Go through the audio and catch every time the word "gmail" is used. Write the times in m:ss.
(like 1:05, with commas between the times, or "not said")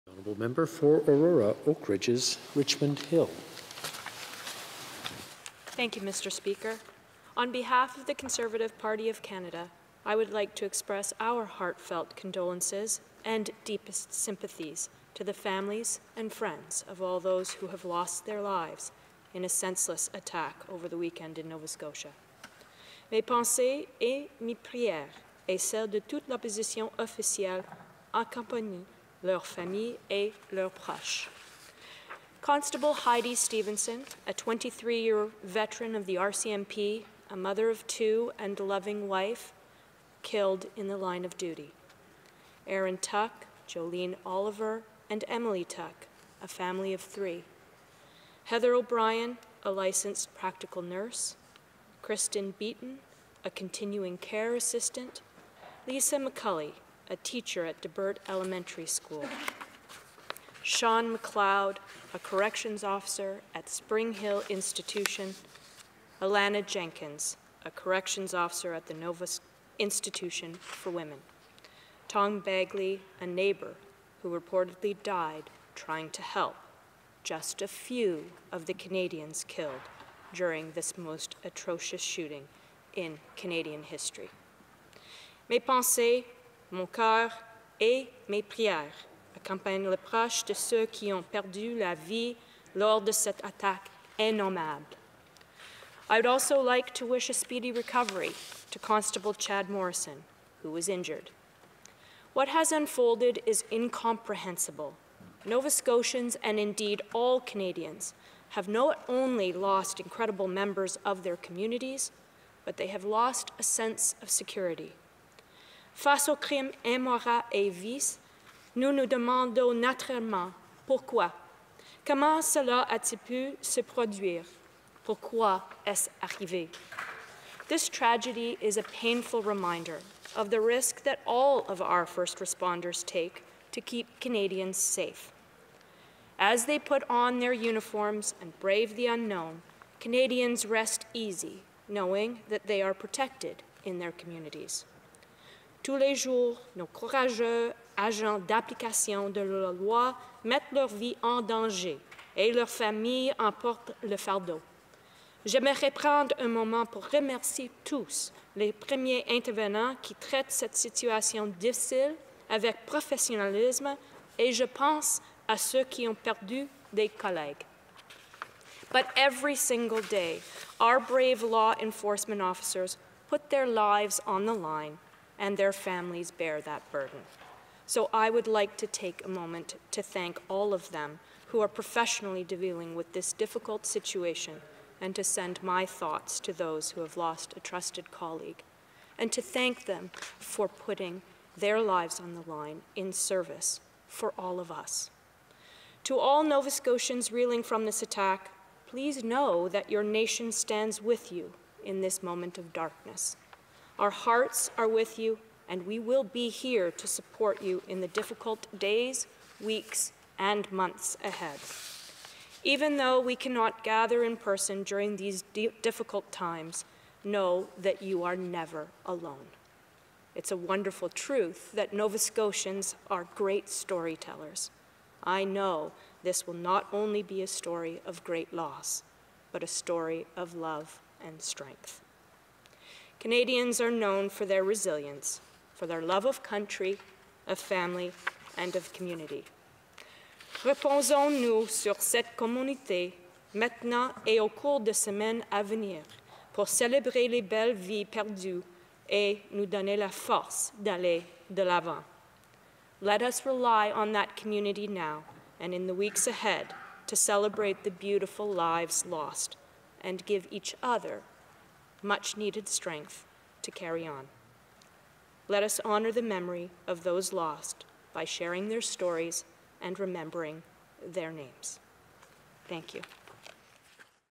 not said.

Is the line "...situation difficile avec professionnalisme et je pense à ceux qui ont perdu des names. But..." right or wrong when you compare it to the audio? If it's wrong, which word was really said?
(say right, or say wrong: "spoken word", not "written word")
wrong: "collègues", not "names".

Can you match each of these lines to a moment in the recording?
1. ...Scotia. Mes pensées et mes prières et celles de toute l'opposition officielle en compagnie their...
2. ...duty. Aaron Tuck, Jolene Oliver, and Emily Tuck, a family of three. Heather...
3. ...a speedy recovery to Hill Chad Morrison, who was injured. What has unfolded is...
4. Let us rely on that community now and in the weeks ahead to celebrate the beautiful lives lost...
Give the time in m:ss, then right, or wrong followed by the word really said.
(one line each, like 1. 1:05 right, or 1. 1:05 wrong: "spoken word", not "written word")
1. 0:21 right
2. 0:41 right
3. 1:37 wrong: "Constable", not "Hill"
4. 4:13 right.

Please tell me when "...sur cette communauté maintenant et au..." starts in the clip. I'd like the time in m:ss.
4:01.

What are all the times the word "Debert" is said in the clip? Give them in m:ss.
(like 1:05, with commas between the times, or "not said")
0:57.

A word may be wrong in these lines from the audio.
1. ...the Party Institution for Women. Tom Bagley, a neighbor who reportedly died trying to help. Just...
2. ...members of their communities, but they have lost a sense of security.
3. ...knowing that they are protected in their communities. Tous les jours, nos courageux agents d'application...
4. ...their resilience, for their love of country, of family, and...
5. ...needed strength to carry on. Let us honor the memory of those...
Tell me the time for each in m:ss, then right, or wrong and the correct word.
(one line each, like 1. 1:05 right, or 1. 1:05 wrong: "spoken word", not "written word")
1. 1:08 wrong: "Nova", not "Party"
2. 1:50 right
3. 2:21 right
4. 3:54 right
5. 4:22 right.